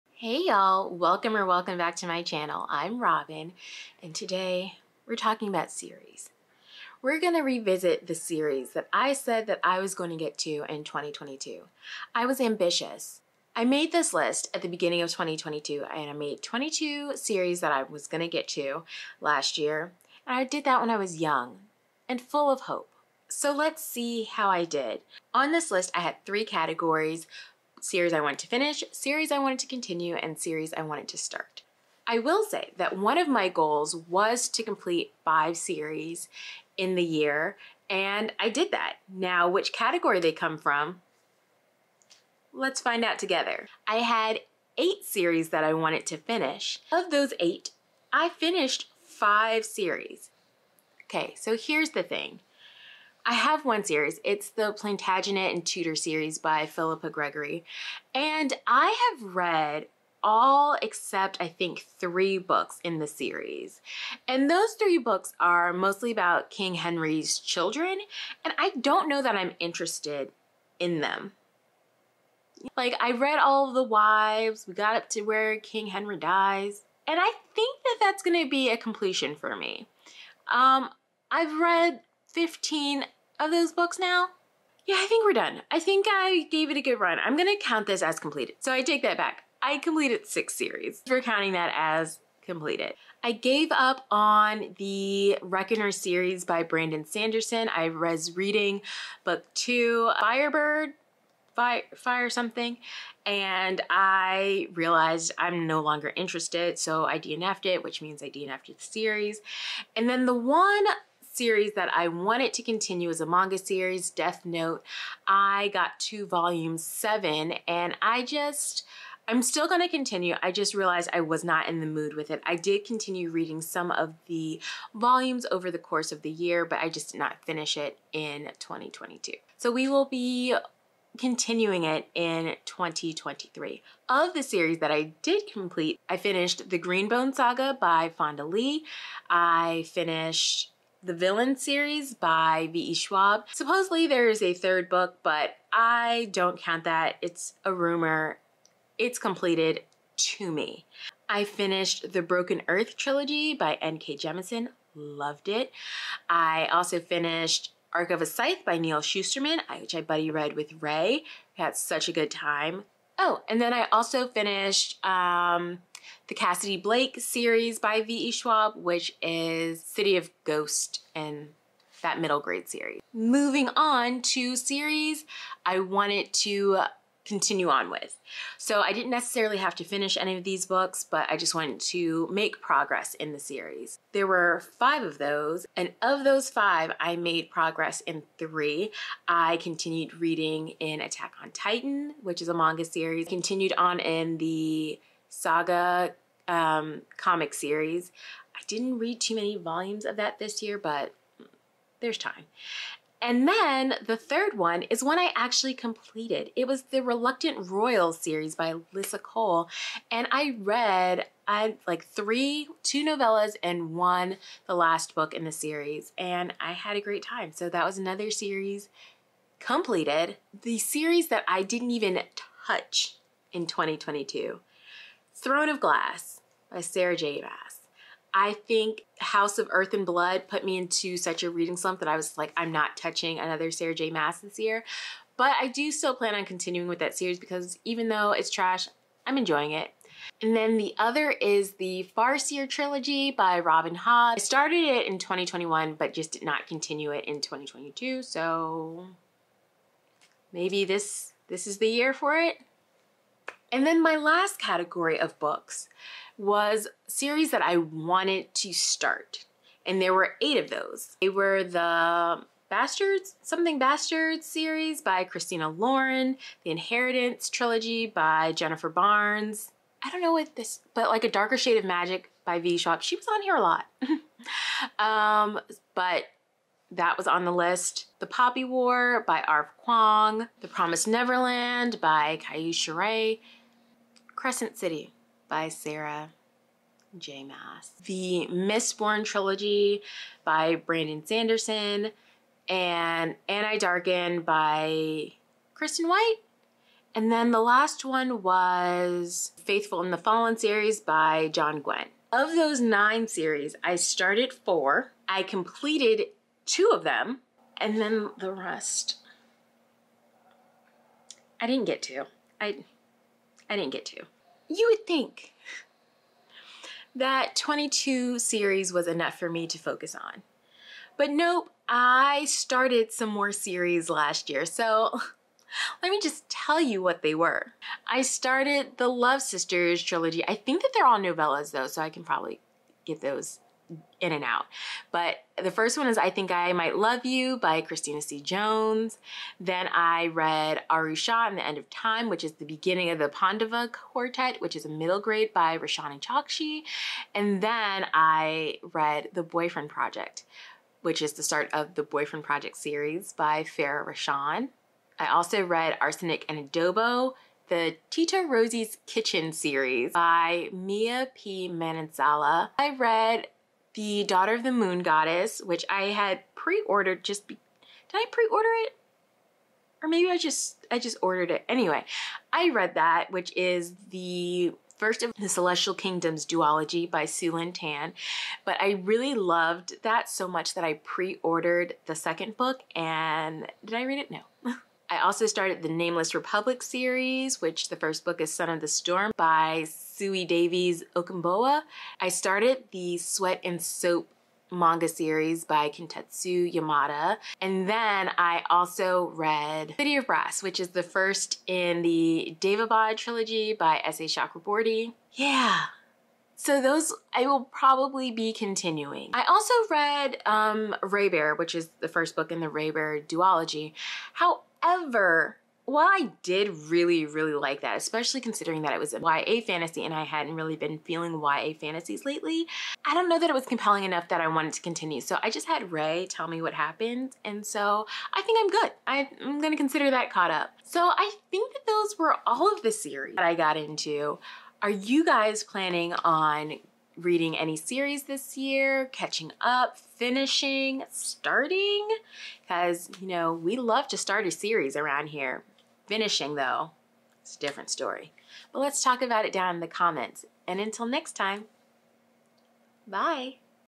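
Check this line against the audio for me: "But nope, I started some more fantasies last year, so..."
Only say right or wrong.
wrong.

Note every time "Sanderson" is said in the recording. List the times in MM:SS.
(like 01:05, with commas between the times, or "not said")
01:37, 04:51.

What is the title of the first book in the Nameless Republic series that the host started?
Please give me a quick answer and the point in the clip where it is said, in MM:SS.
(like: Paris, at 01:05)
Son of the Storm, at 06:28.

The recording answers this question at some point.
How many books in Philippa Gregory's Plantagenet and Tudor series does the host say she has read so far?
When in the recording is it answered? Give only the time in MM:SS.
01:22.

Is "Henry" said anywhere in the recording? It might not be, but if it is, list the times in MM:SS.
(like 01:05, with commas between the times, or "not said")
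01:06, 01:15.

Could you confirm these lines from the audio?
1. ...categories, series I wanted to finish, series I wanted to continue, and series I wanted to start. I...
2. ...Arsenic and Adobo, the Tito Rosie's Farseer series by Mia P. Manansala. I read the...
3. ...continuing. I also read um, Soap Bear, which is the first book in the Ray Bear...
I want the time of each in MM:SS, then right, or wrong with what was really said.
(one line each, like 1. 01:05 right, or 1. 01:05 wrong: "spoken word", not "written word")
1. 00:26 right
2. 05:56 wrong: "Kitchen", not "Farseer"
3. 06:48 wrong: "Ray", not "Soap".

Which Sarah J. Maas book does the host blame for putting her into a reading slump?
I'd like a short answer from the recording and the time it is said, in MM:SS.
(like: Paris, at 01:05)
House of Earth and Blood, at 03:49.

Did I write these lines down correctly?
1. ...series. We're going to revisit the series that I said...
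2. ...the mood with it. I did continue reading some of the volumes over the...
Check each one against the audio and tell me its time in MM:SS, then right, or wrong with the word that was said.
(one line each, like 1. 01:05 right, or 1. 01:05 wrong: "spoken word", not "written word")
1. 00:05 right
2. 02:01 right.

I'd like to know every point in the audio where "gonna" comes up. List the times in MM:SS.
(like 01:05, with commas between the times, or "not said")
01:27, 07:09.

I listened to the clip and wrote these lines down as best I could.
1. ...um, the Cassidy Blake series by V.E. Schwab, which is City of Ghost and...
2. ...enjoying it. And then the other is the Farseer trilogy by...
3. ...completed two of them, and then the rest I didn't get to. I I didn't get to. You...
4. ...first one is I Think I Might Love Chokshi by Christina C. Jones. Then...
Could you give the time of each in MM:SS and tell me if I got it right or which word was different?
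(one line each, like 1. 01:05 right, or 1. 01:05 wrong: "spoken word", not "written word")
1. 02:45 right
2. 03:59 right
3. 05:05 right
4. 05:35 wrong: "You", not "Chokshi".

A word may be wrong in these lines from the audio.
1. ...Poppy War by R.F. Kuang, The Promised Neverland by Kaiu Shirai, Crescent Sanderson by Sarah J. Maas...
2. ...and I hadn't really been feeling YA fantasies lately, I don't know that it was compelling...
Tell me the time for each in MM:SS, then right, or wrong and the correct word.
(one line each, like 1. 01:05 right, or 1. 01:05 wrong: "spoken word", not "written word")
1. 04:38 wrong: "City", not "Sanderson"
2. 07:00 right.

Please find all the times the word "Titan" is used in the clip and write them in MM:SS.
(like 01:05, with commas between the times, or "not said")
03:11.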